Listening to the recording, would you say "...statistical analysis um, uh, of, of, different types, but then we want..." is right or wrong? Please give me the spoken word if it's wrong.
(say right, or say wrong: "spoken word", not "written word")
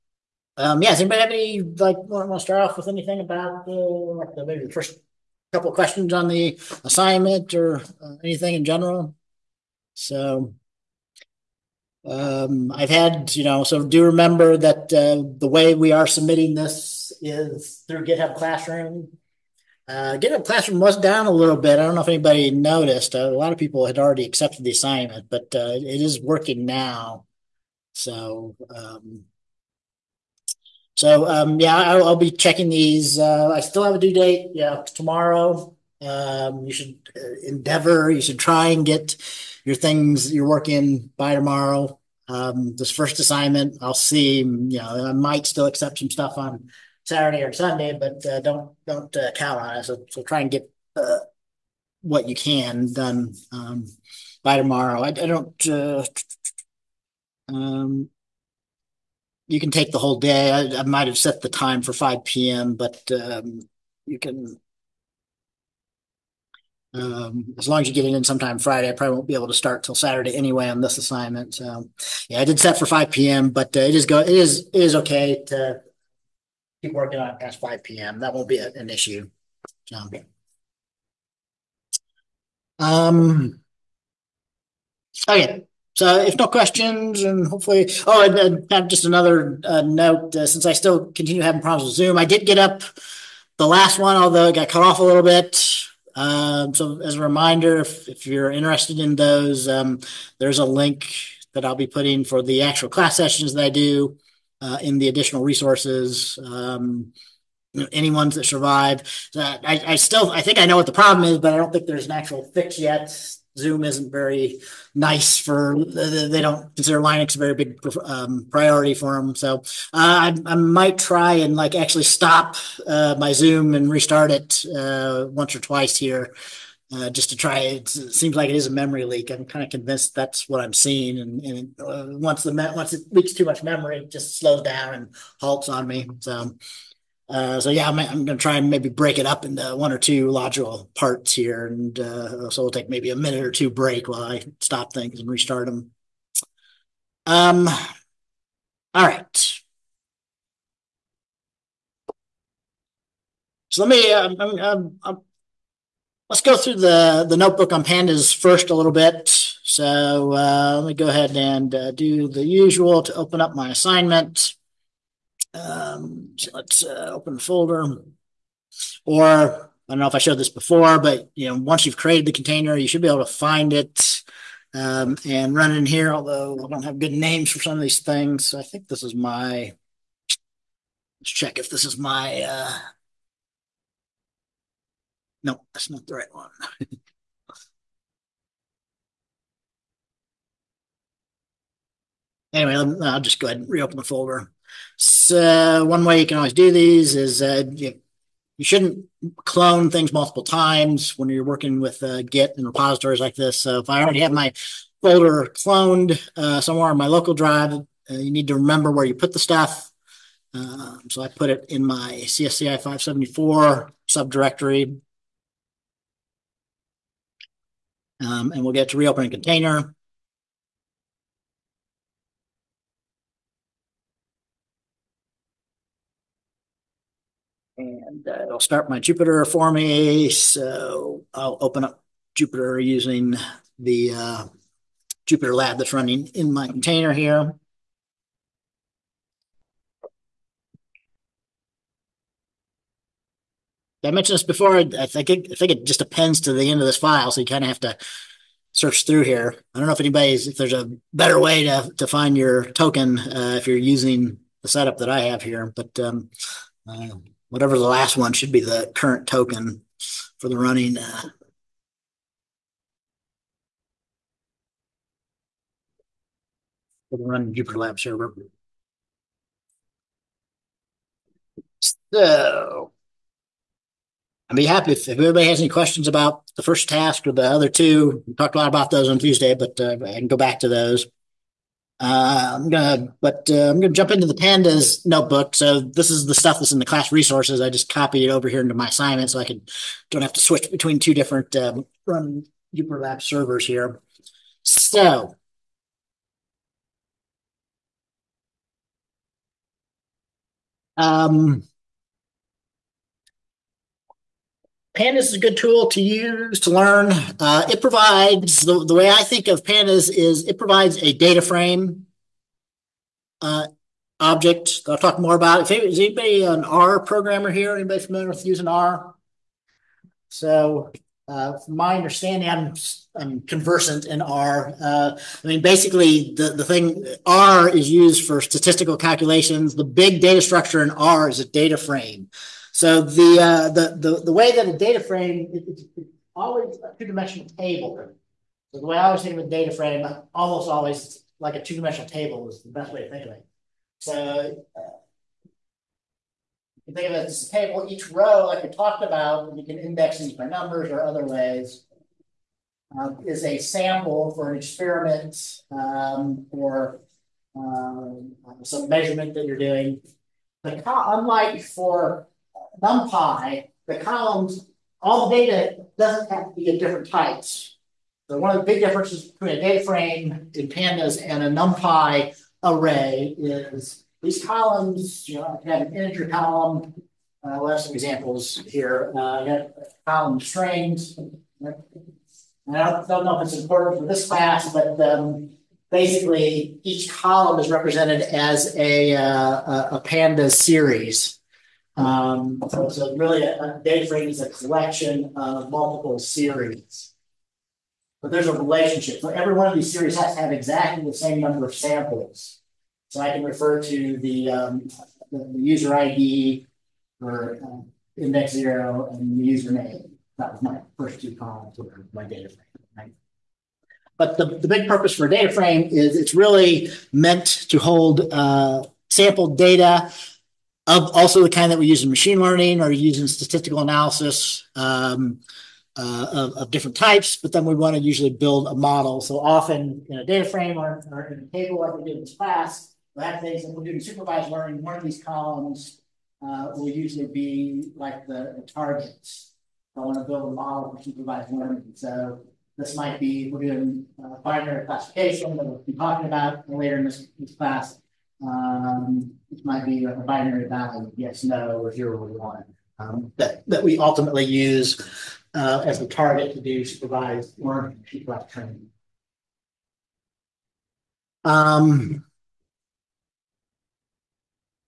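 right.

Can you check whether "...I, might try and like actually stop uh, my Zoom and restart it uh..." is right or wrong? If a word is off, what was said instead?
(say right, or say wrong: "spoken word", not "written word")
right.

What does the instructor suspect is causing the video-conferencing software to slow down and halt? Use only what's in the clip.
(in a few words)
A memory leak.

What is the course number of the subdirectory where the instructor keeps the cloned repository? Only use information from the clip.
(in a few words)
CSCI 574.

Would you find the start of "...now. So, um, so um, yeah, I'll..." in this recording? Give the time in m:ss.
0:26.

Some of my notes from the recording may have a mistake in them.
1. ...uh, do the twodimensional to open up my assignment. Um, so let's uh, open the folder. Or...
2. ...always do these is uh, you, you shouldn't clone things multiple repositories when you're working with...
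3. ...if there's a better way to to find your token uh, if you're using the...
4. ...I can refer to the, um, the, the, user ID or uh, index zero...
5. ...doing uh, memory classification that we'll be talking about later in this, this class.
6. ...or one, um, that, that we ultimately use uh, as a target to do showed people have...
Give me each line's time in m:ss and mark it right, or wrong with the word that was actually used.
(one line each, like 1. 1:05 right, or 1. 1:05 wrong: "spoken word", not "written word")
1. 2:41 wrong: "usual", not "twodimensional"
2. 3:16 wrong: "times", not "repositories"
3. 4:10 right
4. 6:43 right
5. 7:23 wrong: "binary", not "memory"
6. 7:32 wrong: "supervised", not "showed".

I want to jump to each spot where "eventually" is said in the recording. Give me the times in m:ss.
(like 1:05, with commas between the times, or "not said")
not said.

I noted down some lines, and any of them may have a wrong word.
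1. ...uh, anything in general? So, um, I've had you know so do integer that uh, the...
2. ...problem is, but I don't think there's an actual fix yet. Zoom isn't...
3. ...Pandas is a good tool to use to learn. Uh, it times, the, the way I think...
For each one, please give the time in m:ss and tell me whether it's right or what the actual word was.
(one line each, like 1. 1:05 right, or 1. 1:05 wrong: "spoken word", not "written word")
1. 0:08 wrong: "remember", not "integer"
2. 1:50 right
3. 5:04 wrong: "provides", not "times".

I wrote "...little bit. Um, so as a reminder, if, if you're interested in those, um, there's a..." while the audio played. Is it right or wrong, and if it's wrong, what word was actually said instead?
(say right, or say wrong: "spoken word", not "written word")
right.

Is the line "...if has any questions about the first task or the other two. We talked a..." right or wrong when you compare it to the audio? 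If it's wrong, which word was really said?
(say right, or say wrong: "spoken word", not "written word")
right.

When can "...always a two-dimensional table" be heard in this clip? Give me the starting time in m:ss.
5:36.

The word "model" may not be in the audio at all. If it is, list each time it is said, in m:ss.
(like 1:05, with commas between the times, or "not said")
7:08, 7:20.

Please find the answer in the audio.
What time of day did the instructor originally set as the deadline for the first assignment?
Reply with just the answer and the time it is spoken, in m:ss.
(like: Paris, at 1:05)
5 p.m., at 1:01.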